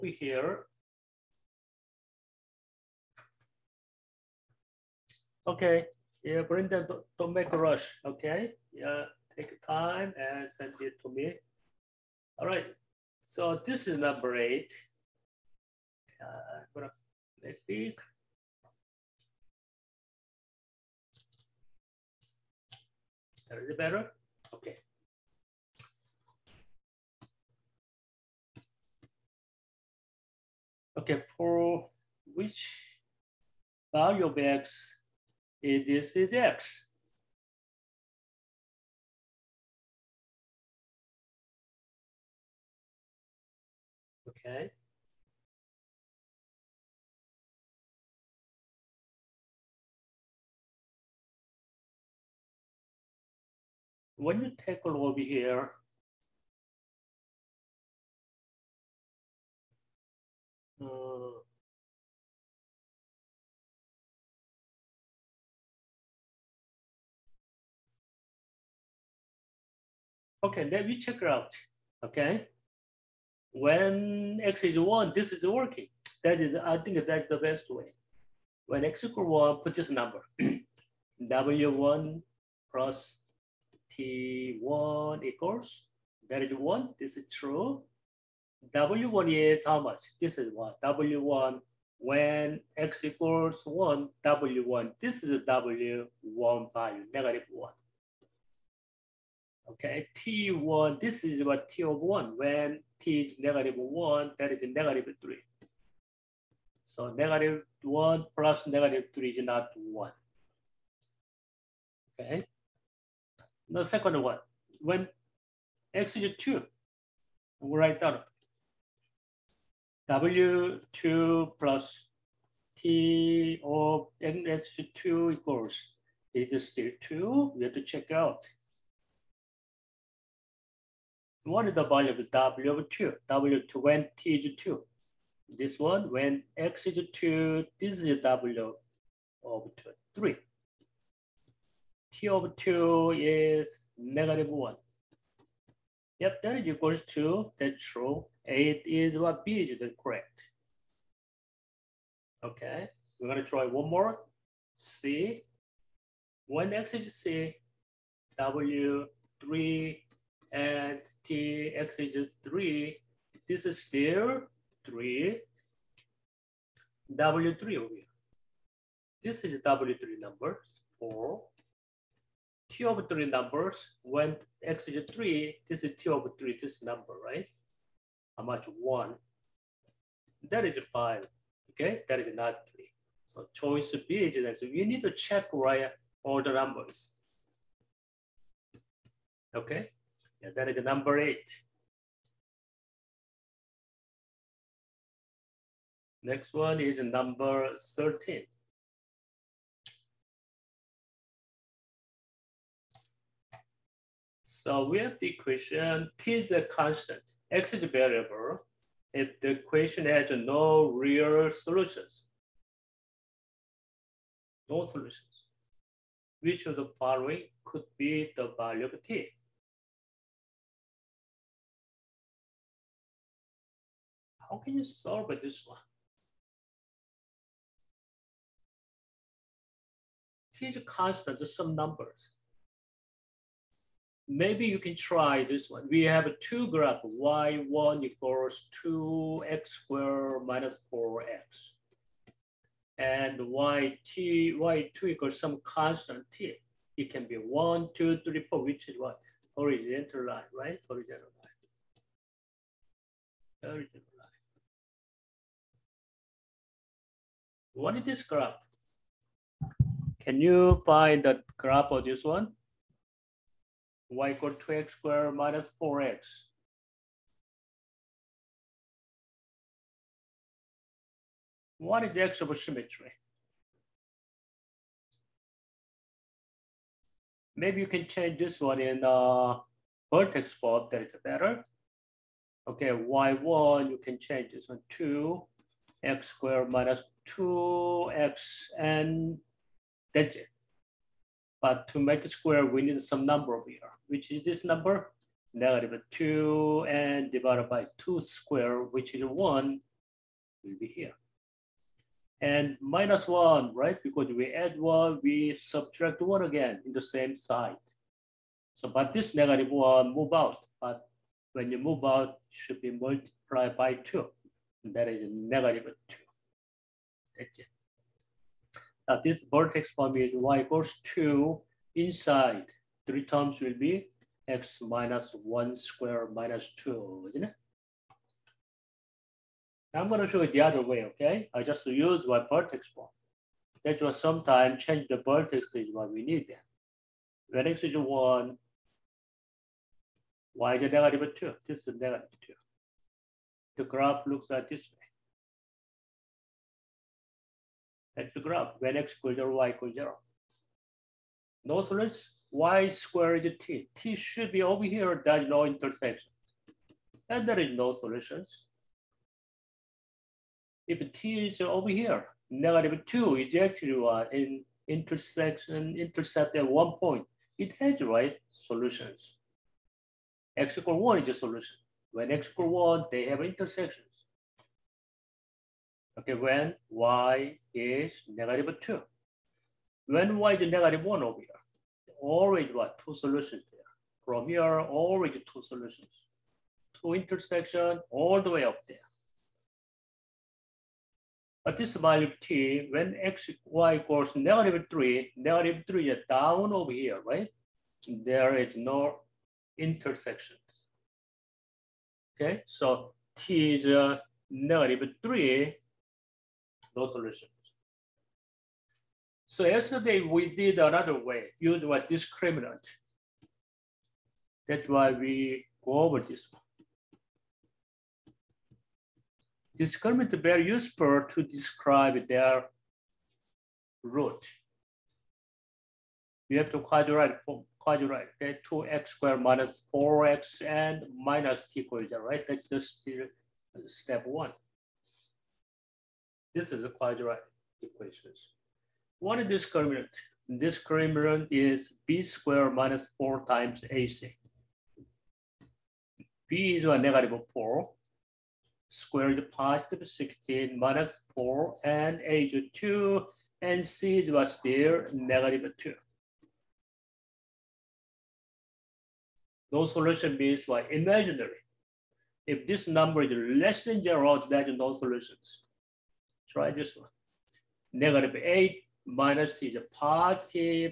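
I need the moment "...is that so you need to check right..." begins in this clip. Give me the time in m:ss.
3:04.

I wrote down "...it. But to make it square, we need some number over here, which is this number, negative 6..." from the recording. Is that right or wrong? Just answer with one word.
wrong.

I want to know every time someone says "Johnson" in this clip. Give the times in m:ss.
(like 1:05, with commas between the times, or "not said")
not said.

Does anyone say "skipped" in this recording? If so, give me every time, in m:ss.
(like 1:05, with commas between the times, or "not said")
not said.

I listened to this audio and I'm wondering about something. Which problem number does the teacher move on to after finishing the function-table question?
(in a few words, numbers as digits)
13.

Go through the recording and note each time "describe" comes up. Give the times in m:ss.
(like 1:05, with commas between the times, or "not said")
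7:01.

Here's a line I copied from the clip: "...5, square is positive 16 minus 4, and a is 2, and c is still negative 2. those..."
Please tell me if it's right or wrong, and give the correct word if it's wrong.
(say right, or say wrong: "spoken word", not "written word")
wrong: "4", not "5".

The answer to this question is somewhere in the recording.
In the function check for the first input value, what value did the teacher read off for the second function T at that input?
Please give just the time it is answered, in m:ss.
1:44.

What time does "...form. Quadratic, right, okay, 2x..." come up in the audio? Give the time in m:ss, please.
7:07.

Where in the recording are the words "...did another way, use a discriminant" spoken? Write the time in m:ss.
6:50.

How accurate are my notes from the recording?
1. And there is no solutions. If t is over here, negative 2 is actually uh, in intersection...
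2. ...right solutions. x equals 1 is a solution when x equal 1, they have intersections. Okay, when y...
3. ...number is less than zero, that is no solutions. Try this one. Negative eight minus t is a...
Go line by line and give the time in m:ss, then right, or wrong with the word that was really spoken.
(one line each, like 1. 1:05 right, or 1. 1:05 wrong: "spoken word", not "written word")
1. 5:57 right
2. 6:08 right
3. 7:42 right.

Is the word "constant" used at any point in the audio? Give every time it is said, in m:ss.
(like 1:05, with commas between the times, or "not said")
3:26, 3:50, 4:05.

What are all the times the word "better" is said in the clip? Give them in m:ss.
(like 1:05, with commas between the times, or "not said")
0:23, 4:41.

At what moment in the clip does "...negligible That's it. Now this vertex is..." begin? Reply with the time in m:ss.
5:15.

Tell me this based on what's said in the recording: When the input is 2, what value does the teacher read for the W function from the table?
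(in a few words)
3.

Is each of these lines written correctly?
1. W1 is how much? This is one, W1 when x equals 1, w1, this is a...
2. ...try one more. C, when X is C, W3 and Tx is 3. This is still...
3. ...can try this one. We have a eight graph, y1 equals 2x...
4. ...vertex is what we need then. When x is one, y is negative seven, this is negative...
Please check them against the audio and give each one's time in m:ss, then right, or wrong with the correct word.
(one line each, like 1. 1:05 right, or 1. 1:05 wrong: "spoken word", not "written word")
1. 1:28 right
2. 2:33 right
3. 3:54 wrong: "two", not "eight"
4. 5:35 wrong: "two", not "seven".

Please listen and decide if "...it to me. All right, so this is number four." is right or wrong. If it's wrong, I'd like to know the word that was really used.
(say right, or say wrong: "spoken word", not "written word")
wrong: "eight", not "four".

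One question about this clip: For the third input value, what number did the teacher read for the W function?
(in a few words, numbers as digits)
4.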